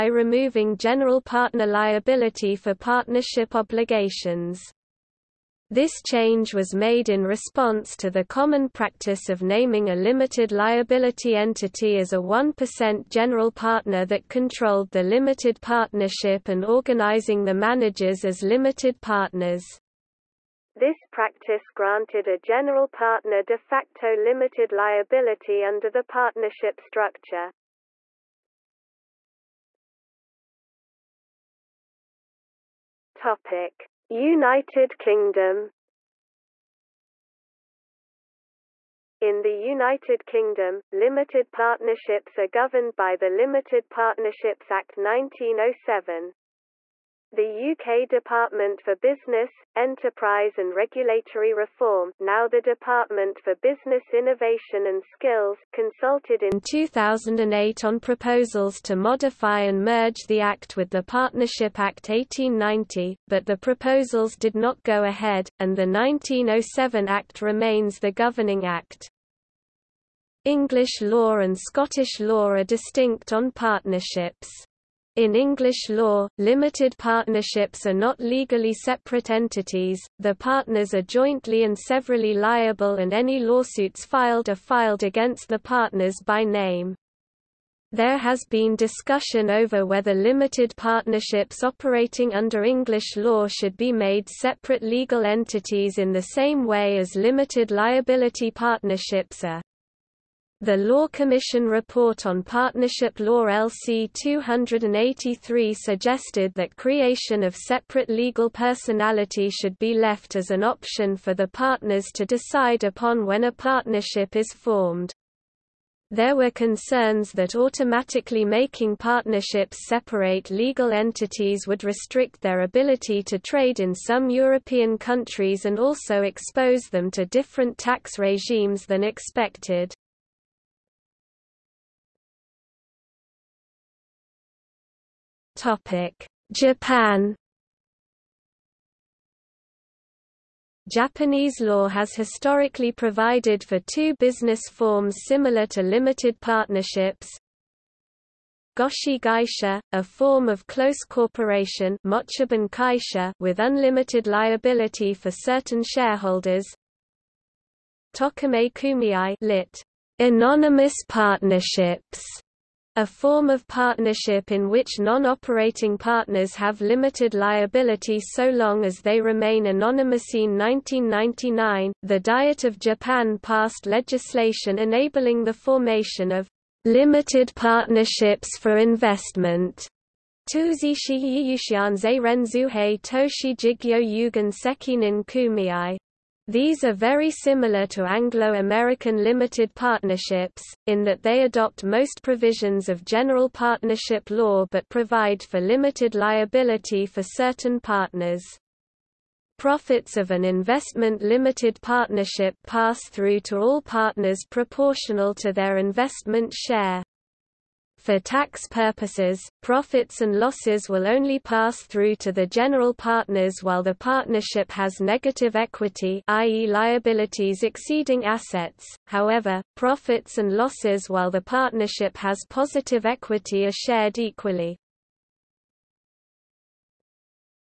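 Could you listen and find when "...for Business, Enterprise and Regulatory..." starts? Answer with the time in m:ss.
0:48.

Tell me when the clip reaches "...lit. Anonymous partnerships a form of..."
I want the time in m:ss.
2:39.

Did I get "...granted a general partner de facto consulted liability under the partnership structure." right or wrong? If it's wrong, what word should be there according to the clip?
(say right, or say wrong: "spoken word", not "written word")
wrong: "limited", not "consulted".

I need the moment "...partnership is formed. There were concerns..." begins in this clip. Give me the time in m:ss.
1:53.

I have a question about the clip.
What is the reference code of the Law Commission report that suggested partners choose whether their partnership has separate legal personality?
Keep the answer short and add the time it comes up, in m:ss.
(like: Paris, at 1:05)
LC 283, at 1:43.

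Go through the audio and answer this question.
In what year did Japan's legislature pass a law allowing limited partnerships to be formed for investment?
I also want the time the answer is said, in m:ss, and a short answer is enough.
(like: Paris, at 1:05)
1999, at 2:50.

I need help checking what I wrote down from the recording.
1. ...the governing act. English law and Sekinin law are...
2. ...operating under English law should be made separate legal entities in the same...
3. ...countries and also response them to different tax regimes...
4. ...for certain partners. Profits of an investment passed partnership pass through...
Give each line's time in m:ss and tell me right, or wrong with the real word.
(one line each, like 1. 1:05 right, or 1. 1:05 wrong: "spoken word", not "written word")
1. 1:07 wrong: "Scottish", not "Sekinin"
2. 1:31 right
3. 2:04 wrong: "expose", not "response"
4. 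3:17 wrong: "limited", not "passed".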